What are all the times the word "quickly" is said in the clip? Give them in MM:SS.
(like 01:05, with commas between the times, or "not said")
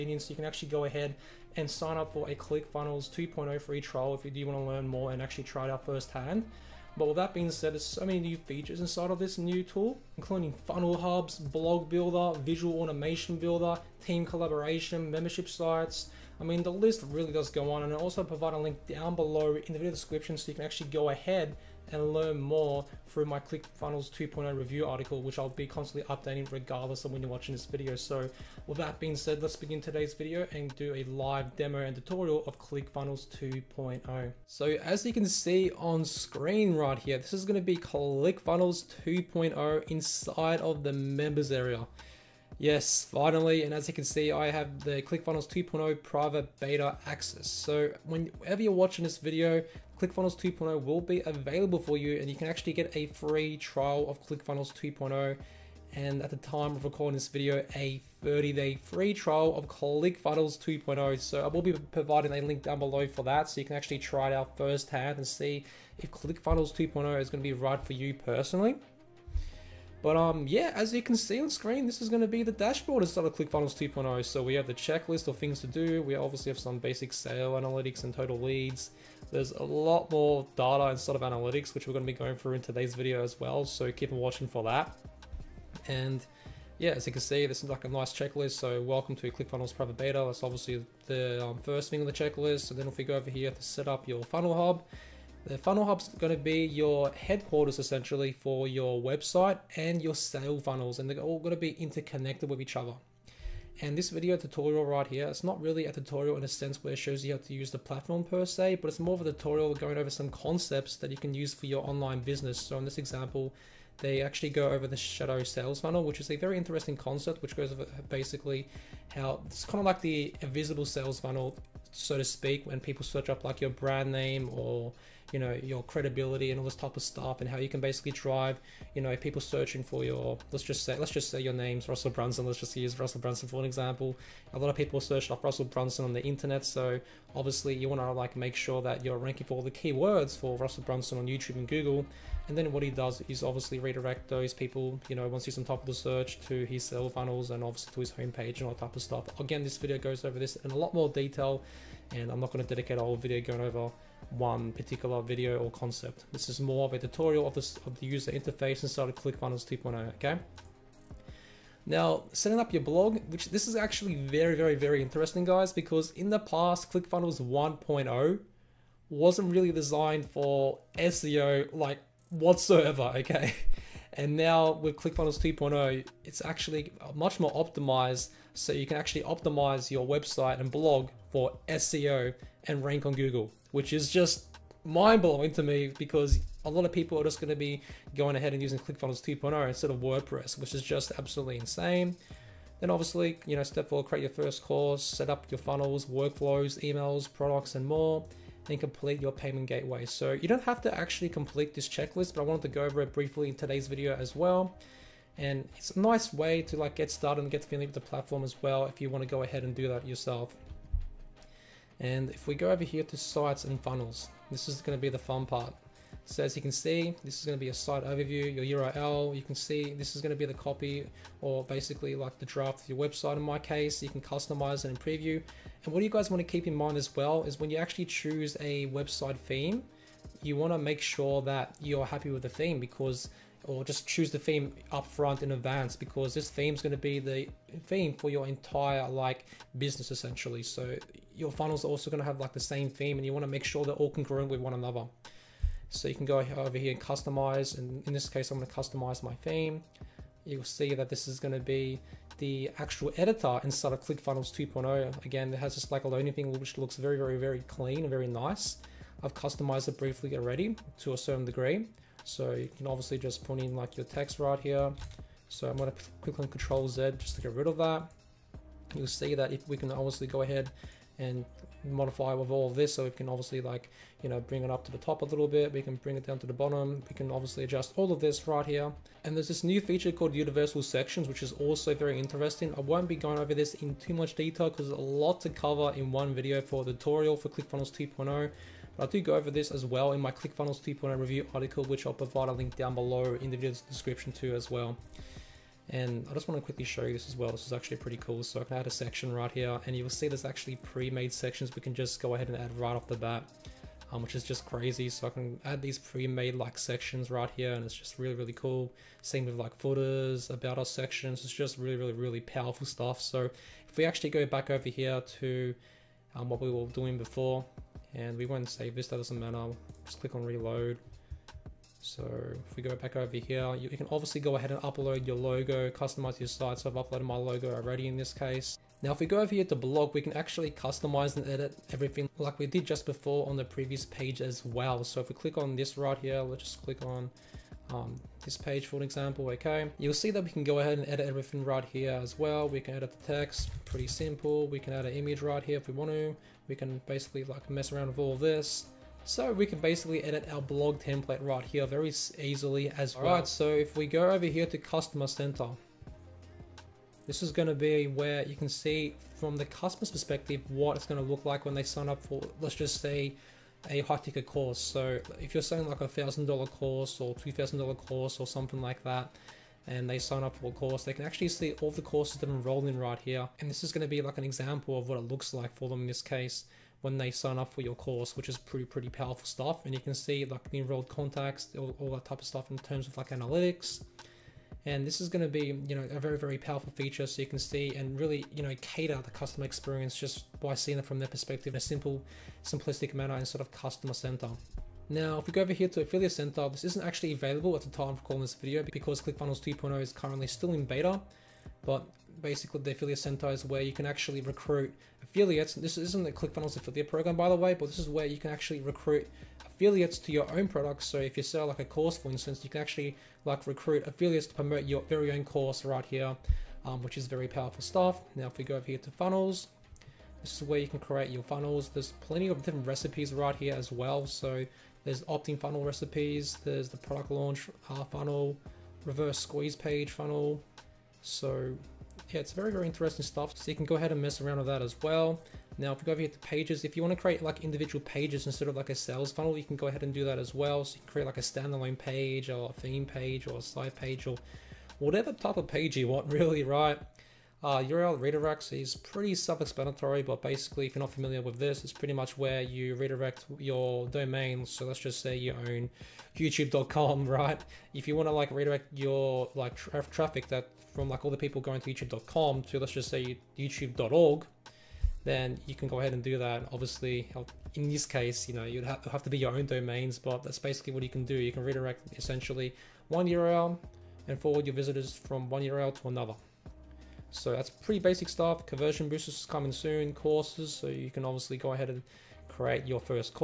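04:56.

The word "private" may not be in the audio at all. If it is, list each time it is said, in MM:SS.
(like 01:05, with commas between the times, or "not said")
00:46, 01:29.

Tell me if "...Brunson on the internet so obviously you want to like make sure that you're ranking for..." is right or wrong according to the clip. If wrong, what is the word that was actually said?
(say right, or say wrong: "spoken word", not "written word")
right.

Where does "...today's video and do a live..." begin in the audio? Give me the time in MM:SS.
00:29.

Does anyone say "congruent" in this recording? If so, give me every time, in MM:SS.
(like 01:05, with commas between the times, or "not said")
04:04.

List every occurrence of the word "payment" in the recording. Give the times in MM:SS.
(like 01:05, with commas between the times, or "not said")
03:19.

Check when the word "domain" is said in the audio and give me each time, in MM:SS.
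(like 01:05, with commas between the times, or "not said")
07:34, 07:49.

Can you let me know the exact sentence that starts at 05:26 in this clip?
So I've uploaded my logo already in this case.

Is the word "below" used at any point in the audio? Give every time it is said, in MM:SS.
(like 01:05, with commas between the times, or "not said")
00:19, 01:02, 04:52.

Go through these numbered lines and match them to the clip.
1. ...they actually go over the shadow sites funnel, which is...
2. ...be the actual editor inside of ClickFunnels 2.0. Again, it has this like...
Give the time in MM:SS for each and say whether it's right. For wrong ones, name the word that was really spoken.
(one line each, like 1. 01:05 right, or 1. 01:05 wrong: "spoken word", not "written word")
1. 01:53 wrong: "sales", not "sites"
2. 04:11 right.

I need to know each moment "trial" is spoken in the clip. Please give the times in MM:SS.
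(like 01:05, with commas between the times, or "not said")
00:03, 00:53, 00:59.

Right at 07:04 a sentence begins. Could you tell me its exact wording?
So there's opt-in funnel recipes, there's the product launch uh, funnel, reverse squeeze page funnel.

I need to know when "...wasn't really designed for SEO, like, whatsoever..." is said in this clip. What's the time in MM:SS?
02:49.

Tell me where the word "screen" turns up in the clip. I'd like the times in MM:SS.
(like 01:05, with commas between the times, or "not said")
00:36, 01:11.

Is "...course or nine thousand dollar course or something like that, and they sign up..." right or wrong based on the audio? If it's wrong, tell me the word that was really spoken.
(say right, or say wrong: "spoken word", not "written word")
wrong: "two", not "nine".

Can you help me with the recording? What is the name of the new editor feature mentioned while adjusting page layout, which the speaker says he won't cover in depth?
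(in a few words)
universal sections.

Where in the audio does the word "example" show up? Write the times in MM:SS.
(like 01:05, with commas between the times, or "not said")
01:52, 02:13, 05:39, 06:14.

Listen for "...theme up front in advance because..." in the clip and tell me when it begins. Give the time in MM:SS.
03:54.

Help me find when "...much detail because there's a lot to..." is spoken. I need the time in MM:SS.
04:44.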